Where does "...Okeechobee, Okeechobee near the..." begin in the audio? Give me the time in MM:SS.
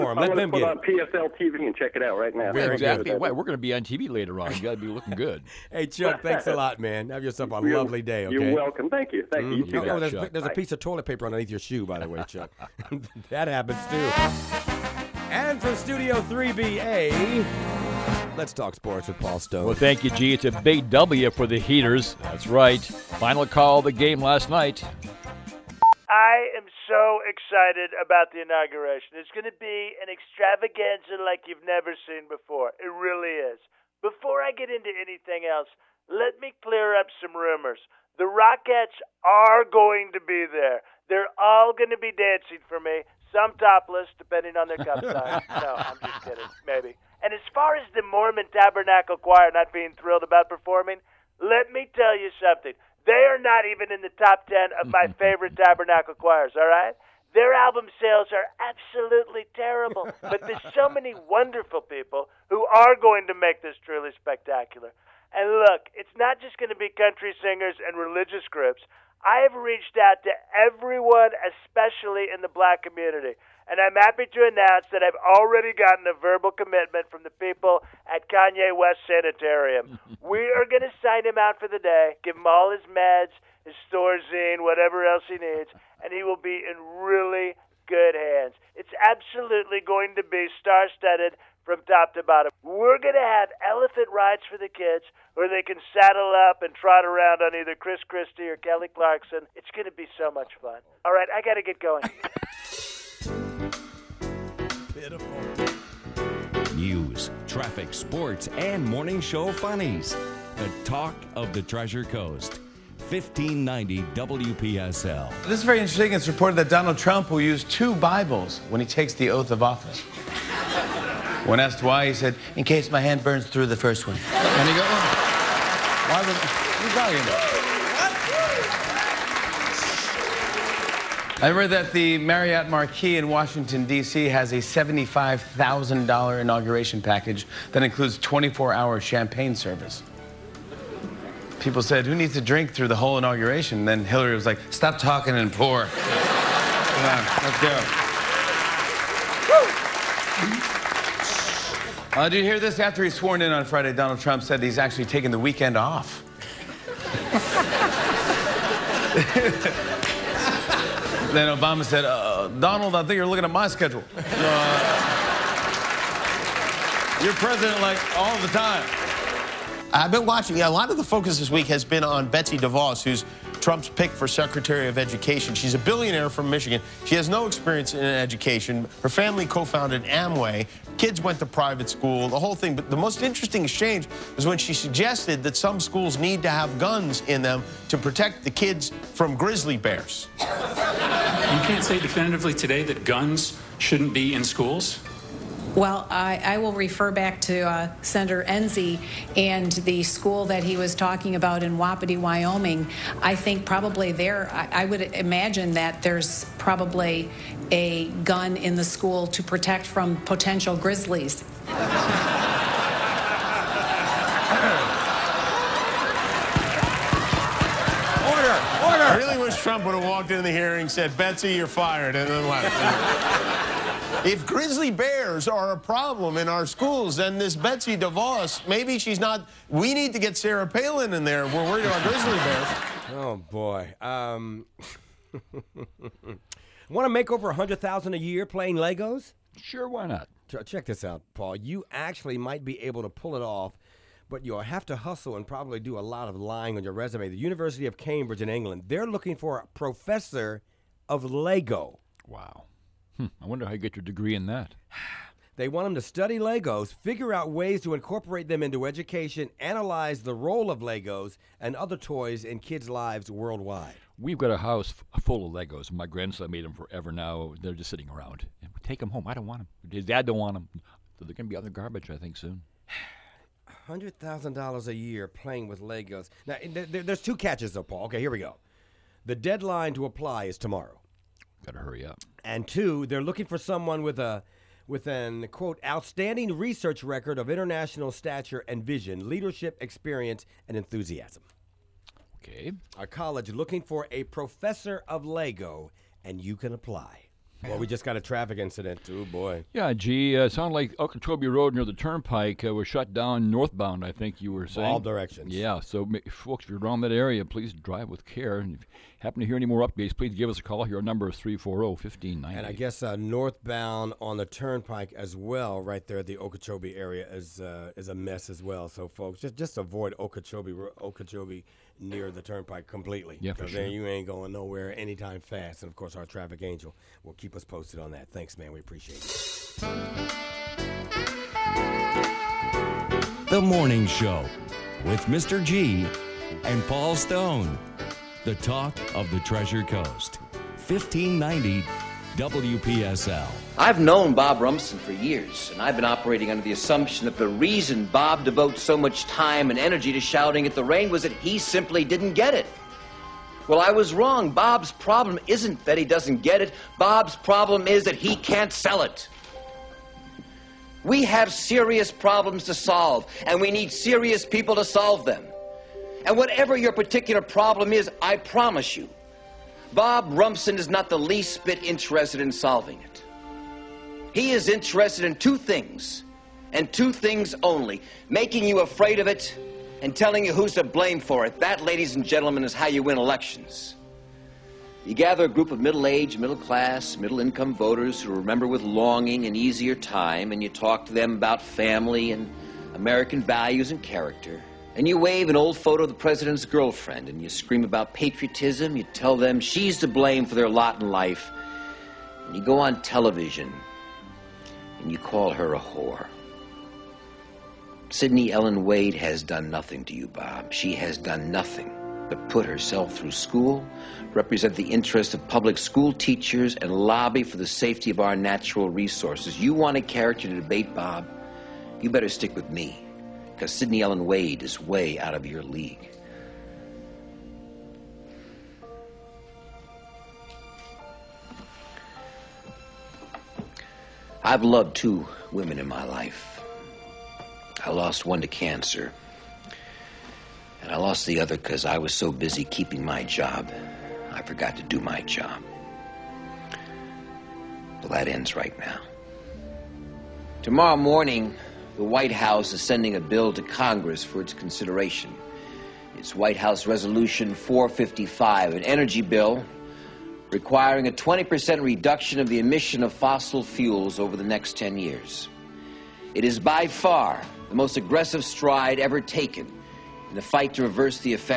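05:20.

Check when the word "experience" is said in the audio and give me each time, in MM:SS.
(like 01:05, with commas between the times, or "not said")
02:57, 04:49.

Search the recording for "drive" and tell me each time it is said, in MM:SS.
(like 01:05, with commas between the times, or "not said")
05:07.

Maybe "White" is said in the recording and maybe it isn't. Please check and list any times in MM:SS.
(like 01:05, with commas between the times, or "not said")
07:32, 07:36.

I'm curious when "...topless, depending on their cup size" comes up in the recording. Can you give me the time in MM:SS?
00:43.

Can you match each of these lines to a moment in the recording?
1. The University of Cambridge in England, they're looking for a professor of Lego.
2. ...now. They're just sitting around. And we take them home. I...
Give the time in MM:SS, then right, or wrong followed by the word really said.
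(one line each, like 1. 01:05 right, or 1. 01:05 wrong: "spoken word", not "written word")
1. 04:07 right
2. 04:27 right.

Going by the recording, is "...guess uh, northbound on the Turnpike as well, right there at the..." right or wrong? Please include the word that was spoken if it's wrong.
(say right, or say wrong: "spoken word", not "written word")
right.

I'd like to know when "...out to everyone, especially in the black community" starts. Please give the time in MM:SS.
01:09.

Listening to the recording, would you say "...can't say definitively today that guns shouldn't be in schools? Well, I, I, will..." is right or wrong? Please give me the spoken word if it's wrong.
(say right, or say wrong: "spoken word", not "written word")
right.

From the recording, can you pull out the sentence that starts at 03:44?
If grizzly bears are a problem in our schools, then this Betsy DeVos, maybe she's not.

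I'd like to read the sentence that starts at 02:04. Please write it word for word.
And he goes, oh, why was...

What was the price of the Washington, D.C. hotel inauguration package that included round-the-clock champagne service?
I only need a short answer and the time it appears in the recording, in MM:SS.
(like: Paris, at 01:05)
$75,000, at 02:14.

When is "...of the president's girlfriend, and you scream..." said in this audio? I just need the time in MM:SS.
06:36.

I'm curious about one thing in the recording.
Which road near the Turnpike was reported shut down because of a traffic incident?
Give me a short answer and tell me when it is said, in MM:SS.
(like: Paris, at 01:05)
Okeechobee Road, at 05:00.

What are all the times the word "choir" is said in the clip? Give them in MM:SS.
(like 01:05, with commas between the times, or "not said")
00:49, 00:56.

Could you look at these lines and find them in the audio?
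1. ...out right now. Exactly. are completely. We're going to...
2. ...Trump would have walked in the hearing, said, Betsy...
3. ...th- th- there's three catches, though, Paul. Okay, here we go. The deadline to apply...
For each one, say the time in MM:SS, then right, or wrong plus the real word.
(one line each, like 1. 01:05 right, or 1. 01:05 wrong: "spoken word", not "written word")
1. 00:02 wrong: "exactly", not "completely"
2. 03:39 right
3. 04:36 wrong: "two", not "three".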